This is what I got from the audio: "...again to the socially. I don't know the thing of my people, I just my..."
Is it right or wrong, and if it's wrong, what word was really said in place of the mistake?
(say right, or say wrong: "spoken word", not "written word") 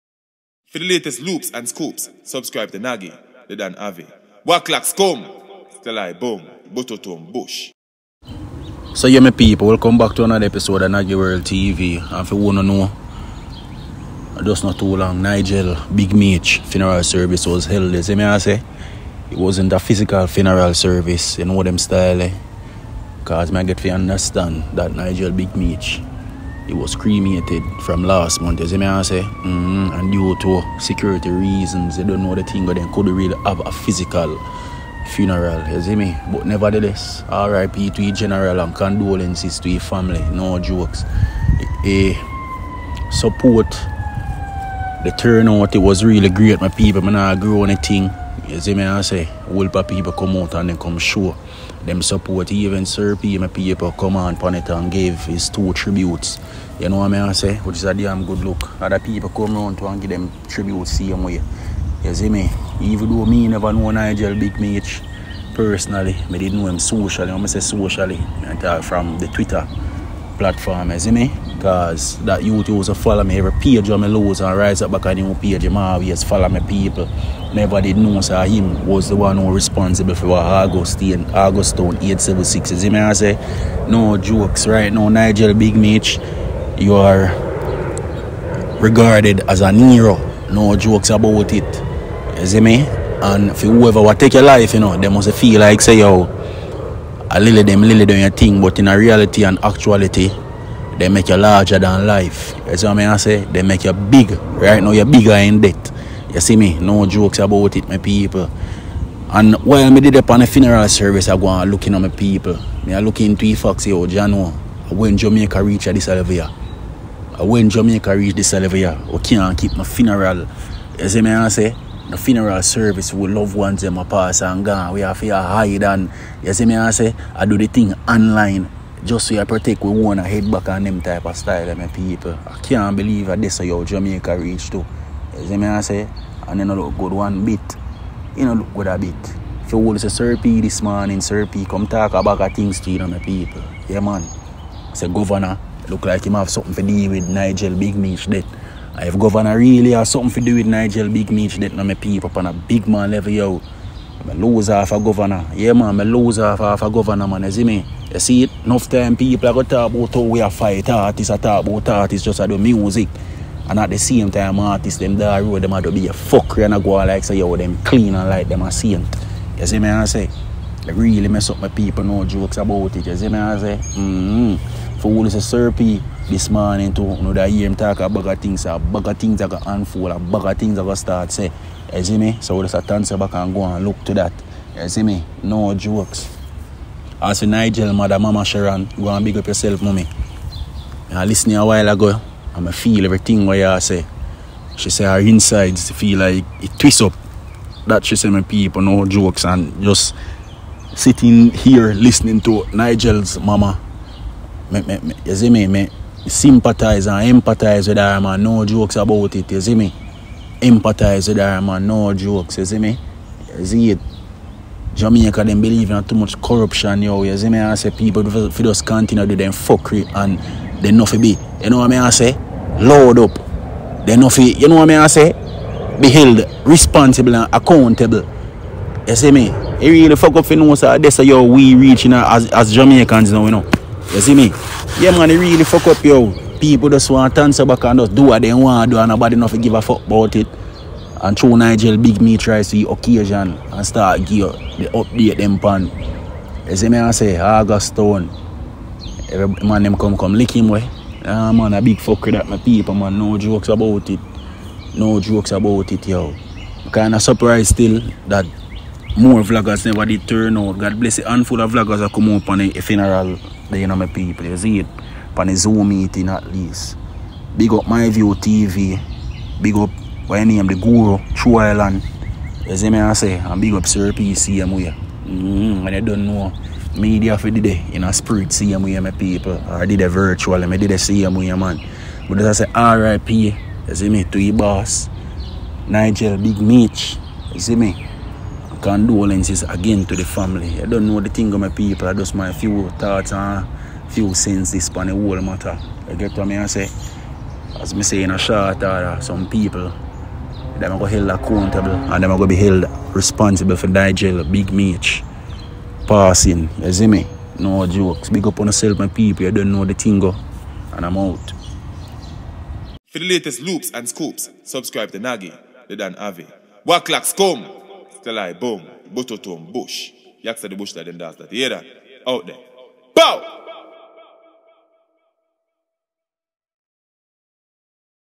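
wrong: "family", not "socially".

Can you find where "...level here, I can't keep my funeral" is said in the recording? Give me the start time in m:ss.
1:58.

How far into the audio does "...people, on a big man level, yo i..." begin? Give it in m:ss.
2:31.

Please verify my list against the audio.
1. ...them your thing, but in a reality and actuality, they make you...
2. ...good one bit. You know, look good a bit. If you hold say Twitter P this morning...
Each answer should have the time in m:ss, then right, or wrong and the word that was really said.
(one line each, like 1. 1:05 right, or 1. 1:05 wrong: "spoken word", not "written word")
1. 1:38 right
2. 2:16 wrong: "Sir", not "Twitter".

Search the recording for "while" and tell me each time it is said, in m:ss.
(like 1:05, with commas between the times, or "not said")
1:49, 3:11.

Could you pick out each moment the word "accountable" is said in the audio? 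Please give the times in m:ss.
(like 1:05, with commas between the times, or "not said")
3:47, 5:01.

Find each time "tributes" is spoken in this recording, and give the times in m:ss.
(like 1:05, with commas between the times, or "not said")
0:55, 1:00.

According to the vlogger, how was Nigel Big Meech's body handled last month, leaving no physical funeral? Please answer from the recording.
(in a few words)
Cremated.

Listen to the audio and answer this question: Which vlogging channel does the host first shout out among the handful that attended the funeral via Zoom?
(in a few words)
My View TV.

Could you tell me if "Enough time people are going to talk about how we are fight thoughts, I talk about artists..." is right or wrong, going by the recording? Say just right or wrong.
wrong.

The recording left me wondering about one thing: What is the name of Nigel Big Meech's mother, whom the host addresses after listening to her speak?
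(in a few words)
Sharon.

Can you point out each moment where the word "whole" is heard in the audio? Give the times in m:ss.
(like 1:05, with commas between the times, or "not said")
0:49, 4:55.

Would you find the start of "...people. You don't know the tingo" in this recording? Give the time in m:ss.
5:09.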